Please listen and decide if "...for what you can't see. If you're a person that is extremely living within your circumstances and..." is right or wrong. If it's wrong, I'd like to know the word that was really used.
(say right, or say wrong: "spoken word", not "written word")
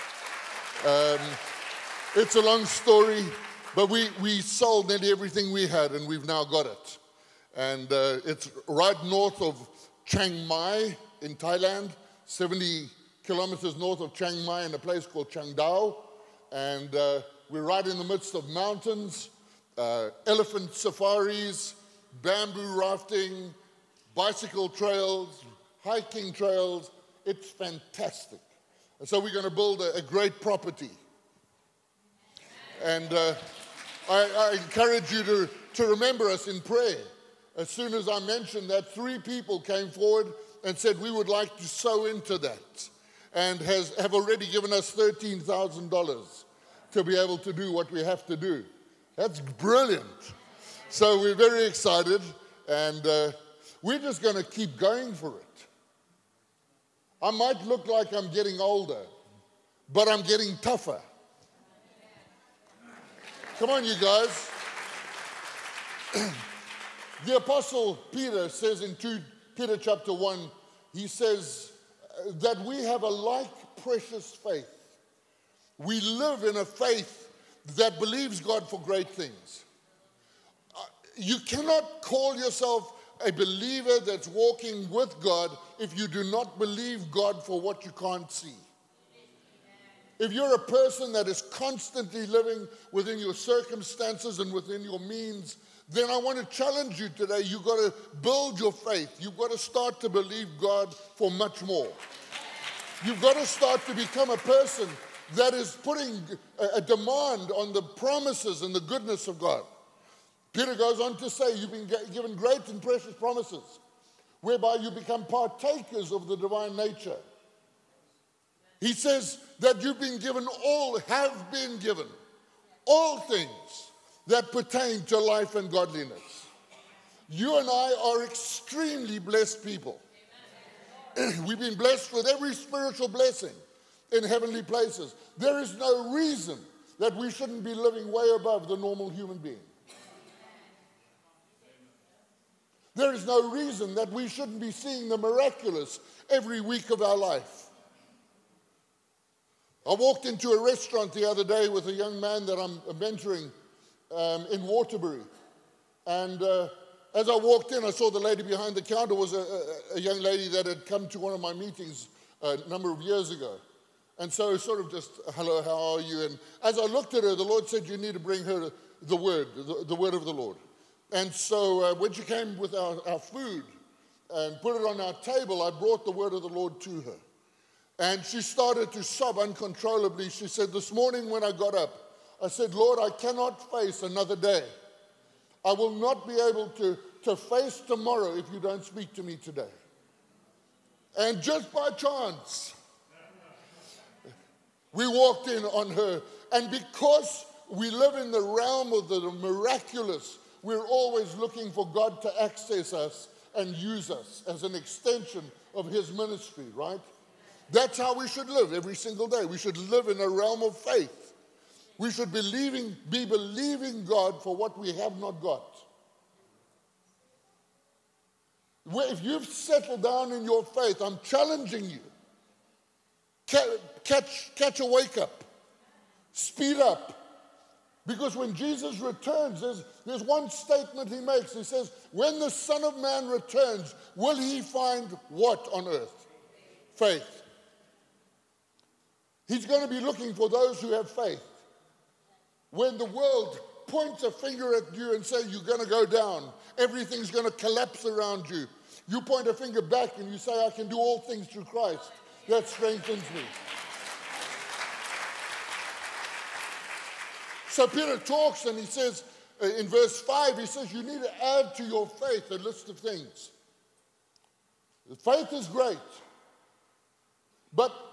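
wrong: "constantly", not "extremely".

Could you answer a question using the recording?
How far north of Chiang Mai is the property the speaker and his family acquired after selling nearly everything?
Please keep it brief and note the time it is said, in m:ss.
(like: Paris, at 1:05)
70 kilometers, at 0:12.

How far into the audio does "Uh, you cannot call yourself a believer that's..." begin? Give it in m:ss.
1:20.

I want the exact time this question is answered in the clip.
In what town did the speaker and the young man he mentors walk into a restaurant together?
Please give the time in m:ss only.
2:34.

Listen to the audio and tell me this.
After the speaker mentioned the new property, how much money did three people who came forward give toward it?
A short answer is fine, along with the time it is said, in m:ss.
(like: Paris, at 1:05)
$13,000, at 0:44.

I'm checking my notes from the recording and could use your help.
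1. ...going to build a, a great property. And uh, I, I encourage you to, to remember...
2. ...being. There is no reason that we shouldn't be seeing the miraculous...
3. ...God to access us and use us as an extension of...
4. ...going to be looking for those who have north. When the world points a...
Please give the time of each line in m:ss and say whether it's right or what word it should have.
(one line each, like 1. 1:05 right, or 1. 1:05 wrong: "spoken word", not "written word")
1. 0:29 right
2. 2:19 right
3. 3:21 right
4. 3:59 wrong: "faith", not "north".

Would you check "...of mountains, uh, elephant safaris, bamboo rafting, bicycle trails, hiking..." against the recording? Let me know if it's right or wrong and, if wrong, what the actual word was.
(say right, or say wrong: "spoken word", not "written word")
right.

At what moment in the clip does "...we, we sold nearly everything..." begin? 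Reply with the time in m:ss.
0:03.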